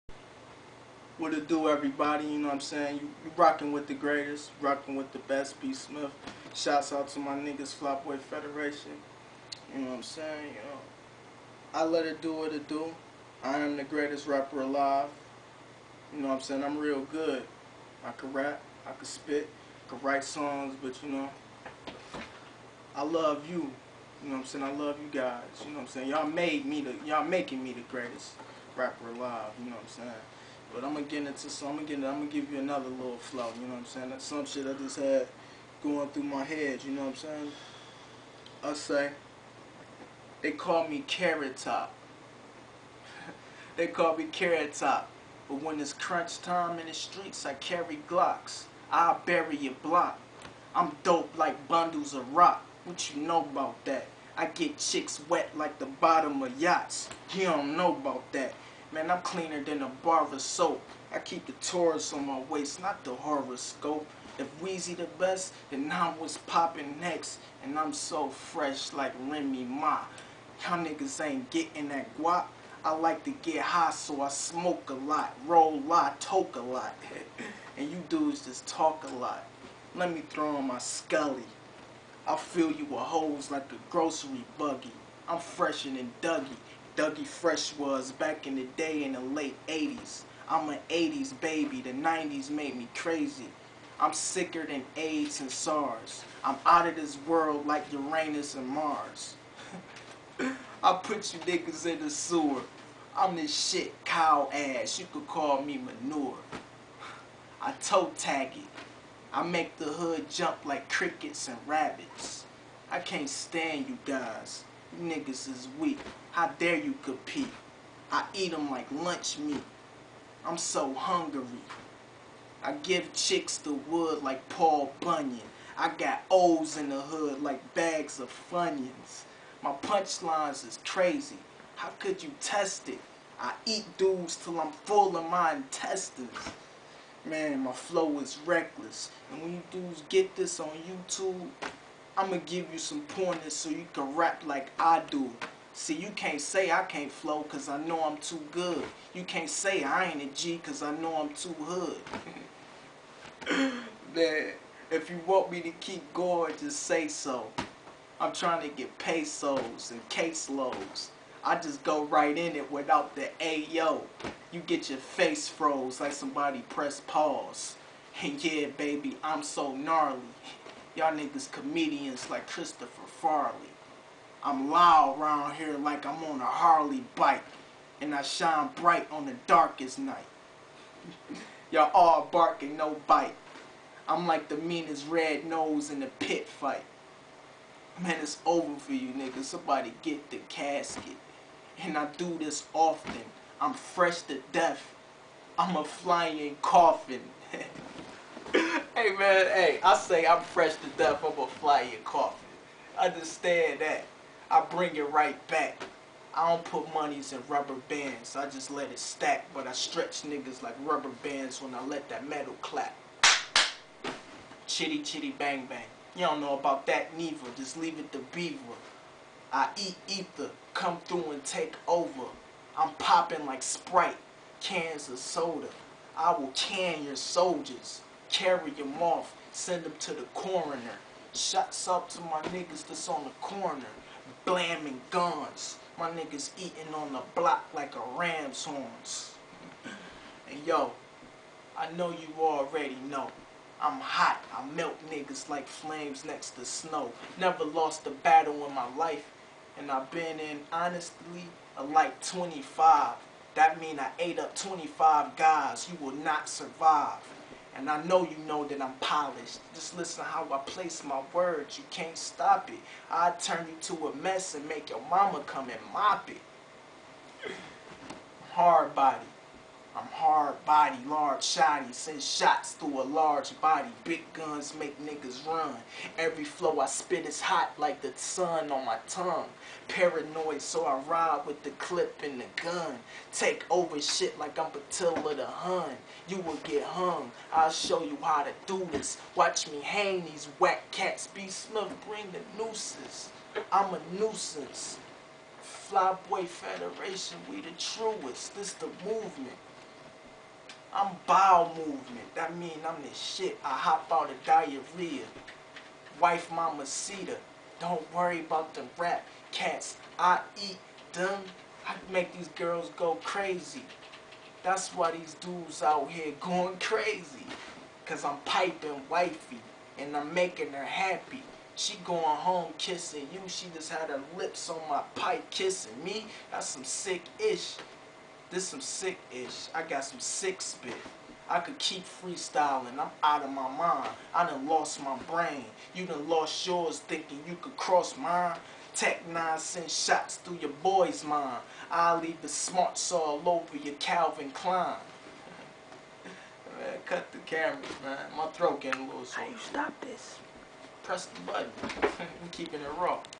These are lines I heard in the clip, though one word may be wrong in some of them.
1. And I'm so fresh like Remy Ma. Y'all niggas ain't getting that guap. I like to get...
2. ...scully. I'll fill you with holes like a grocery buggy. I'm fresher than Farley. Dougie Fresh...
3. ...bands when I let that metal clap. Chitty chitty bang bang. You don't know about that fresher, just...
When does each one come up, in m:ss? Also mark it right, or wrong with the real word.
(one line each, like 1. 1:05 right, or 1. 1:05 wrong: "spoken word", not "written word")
1. 1:07 right
2. 1:20 wrong: "Dougie", not "Farley"
3. 3:31 wrong: "neither", not "fresher".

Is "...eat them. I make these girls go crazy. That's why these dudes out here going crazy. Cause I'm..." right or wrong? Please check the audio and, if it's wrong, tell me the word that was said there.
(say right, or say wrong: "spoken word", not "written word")
right.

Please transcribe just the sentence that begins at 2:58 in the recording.
And I shine bright on the darkest night.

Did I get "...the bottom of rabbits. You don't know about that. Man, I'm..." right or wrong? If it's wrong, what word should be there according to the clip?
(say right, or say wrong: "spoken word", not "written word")
wrong: "yachts", not "rabbits".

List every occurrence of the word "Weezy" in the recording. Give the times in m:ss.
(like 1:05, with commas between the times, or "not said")
1:04.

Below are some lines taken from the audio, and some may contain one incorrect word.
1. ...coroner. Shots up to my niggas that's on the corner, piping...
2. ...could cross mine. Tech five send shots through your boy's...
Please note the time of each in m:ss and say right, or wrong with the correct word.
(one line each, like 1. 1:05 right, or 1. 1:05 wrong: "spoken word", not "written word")
1. 3:50 wrong: "blaming", not "piping"
2. 5:37 wrong: "nine", not "five".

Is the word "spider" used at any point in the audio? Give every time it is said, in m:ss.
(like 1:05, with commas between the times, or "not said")
not said.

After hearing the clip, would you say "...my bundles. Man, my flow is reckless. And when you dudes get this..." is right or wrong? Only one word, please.
wrong.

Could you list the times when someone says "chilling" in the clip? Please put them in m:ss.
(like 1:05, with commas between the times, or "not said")
not said.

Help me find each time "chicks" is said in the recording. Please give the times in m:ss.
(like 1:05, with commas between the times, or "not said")
0:54, 2:03.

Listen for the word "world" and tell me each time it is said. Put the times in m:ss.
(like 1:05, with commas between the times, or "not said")
1:37.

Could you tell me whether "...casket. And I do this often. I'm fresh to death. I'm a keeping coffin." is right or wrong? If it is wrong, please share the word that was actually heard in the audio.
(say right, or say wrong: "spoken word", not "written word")
wrong: "flying", not "keeping".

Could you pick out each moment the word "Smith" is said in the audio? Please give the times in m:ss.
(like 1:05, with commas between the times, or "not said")
0:05, 4:51.